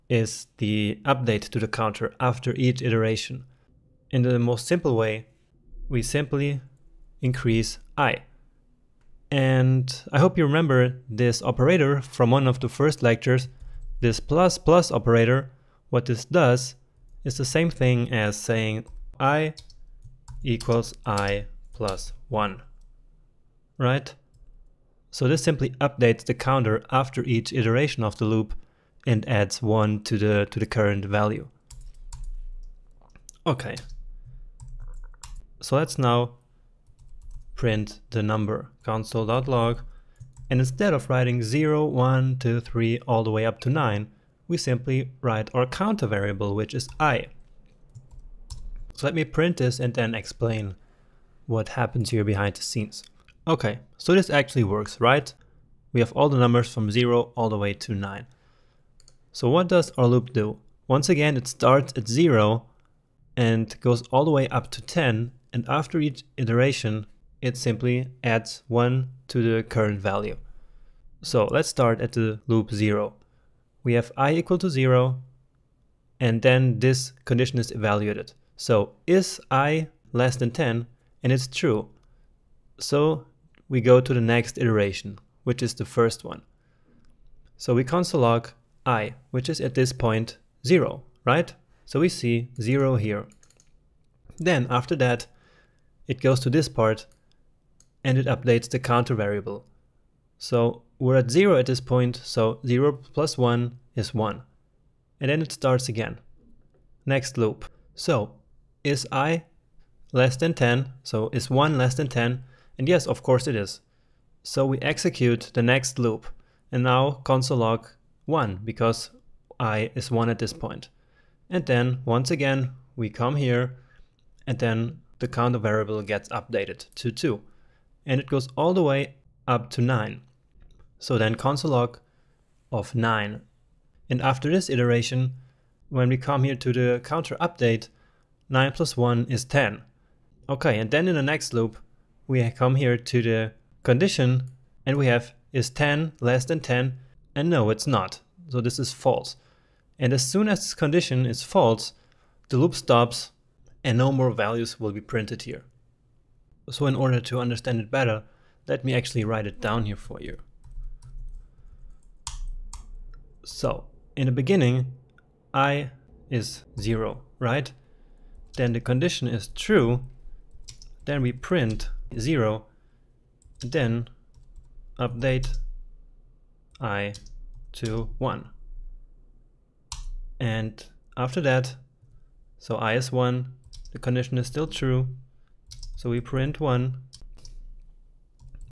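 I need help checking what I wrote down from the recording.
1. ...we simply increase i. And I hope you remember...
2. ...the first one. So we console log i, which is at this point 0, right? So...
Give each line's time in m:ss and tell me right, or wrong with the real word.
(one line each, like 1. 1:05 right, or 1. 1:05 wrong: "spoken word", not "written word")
1. 0:05 right
2. 1:25 right.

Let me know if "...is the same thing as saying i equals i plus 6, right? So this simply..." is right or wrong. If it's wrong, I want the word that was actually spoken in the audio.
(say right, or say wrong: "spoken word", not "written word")
wrong: "1", not "6".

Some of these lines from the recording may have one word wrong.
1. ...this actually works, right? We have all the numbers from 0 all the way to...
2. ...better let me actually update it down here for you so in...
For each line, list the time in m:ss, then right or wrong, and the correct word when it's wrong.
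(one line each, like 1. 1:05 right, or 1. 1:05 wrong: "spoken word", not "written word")
1. 0:54 right
2. 2:37 wrong: "write", not "update".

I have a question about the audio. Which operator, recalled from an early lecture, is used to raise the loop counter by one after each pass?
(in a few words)
++ (plus plus).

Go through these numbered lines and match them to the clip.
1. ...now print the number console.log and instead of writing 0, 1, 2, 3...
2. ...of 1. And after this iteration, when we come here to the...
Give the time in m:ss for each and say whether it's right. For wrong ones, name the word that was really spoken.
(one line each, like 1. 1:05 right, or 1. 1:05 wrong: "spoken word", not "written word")
1. 0:35 right
2. 2:12 wrong: "9", not "1".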